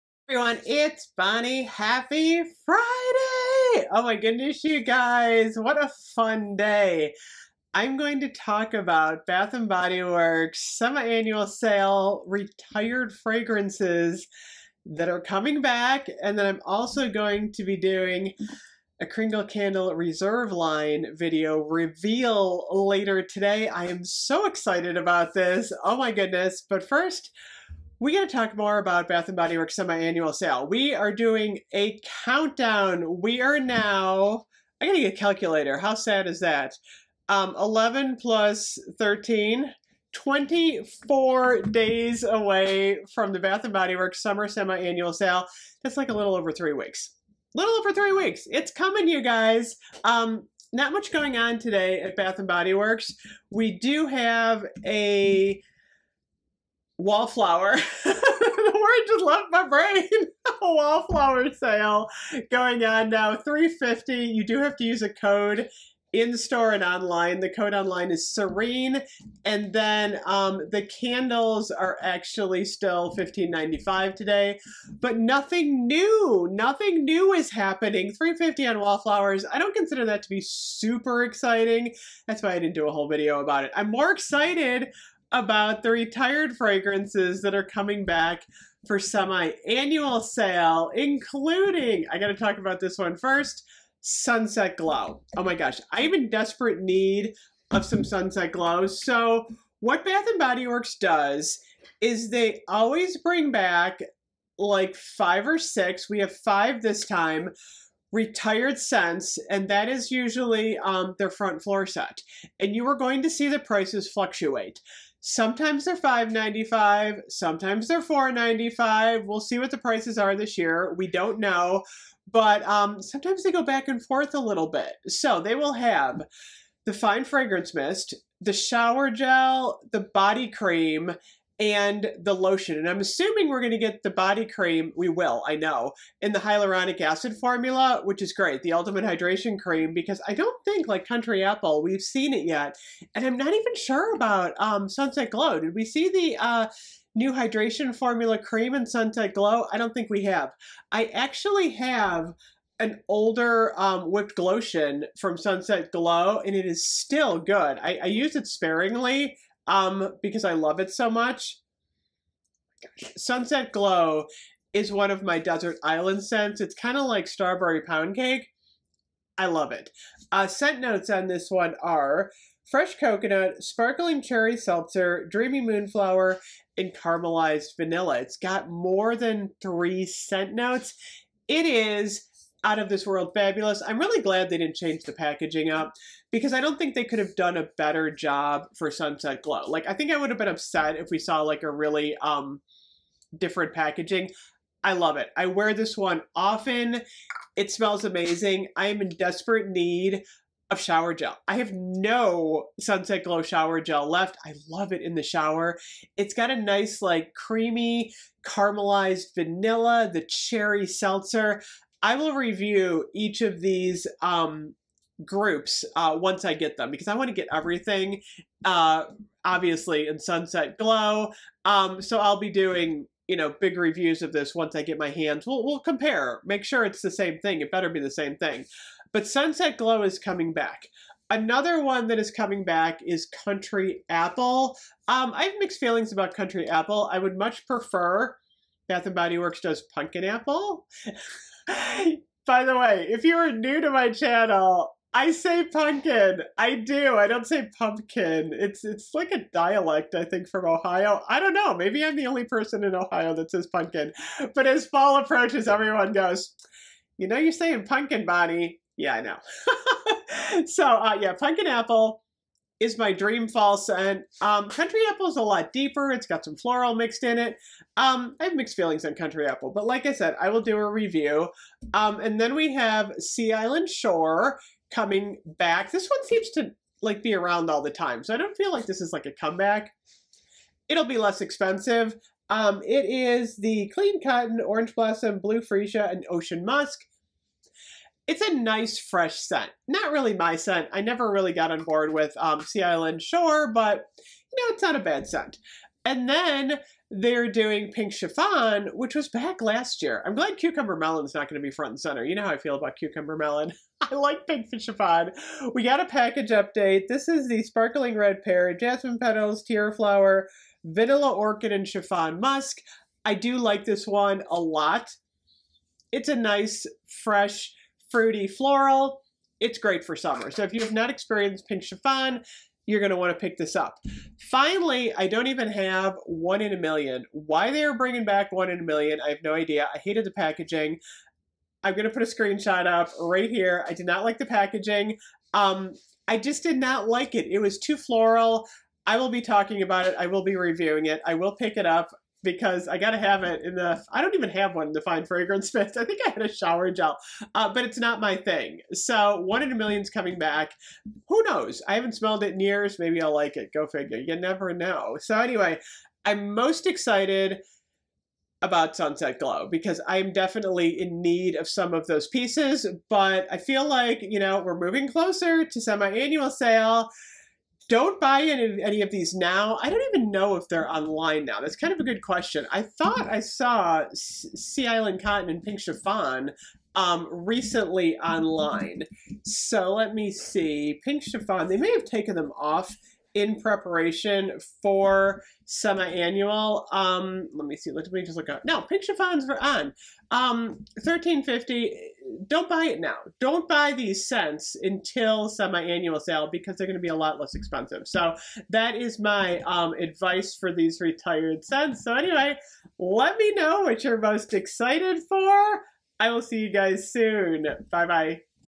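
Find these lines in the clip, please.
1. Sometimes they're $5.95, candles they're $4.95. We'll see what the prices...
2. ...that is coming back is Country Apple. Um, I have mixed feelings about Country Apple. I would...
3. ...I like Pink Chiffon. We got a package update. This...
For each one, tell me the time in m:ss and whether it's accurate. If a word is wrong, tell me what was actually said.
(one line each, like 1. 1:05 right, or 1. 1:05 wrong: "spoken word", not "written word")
1. 1:55 wrong: "sometimes", not "candles"
2. 3:52 right
3. 5:04 right.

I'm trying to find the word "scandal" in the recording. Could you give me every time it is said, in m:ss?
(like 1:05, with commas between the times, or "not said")
not said.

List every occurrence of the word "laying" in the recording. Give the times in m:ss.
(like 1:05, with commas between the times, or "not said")
not said.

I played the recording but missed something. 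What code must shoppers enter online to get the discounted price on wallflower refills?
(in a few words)
Serene.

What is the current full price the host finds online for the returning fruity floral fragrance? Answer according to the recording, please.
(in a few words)
$13.50.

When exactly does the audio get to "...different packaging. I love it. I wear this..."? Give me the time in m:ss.
3:13.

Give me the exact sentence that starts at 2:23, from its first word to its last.
And I'm not even sure about um, Sunset Glow.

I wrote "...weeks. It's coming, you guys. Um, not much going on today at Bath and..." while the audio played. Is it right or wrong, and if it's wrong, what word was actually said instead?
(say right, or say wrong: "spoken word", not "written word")
right.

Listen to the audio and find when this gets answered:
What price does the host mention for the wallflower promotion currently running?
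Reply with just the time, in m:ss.
1:03.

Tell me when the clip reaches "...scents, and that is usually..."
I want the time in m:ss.
1:48.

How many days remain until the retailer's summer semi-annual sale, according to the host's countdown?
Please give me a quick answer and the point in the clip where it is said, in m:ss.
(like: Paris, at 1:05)
24, at 0:40.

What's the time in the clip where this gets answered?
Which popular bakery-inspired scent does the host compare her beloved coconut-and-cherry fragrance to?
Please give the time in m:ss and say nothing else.
2:47.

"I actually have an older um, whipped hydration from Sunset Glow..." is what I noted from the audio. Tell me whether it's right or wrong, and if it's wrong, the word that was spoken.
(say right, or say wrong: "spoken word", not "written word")
wrong: "lotion", not "hydration".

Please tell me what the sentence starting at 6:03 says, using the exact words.
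But I feel like you know we're moving closer to semi-annual sale don't buy any, any of these now.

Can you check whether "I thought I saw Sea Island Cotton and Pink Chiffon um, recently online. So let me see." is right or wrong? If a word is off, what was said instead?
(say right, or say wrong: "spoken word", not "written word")
right.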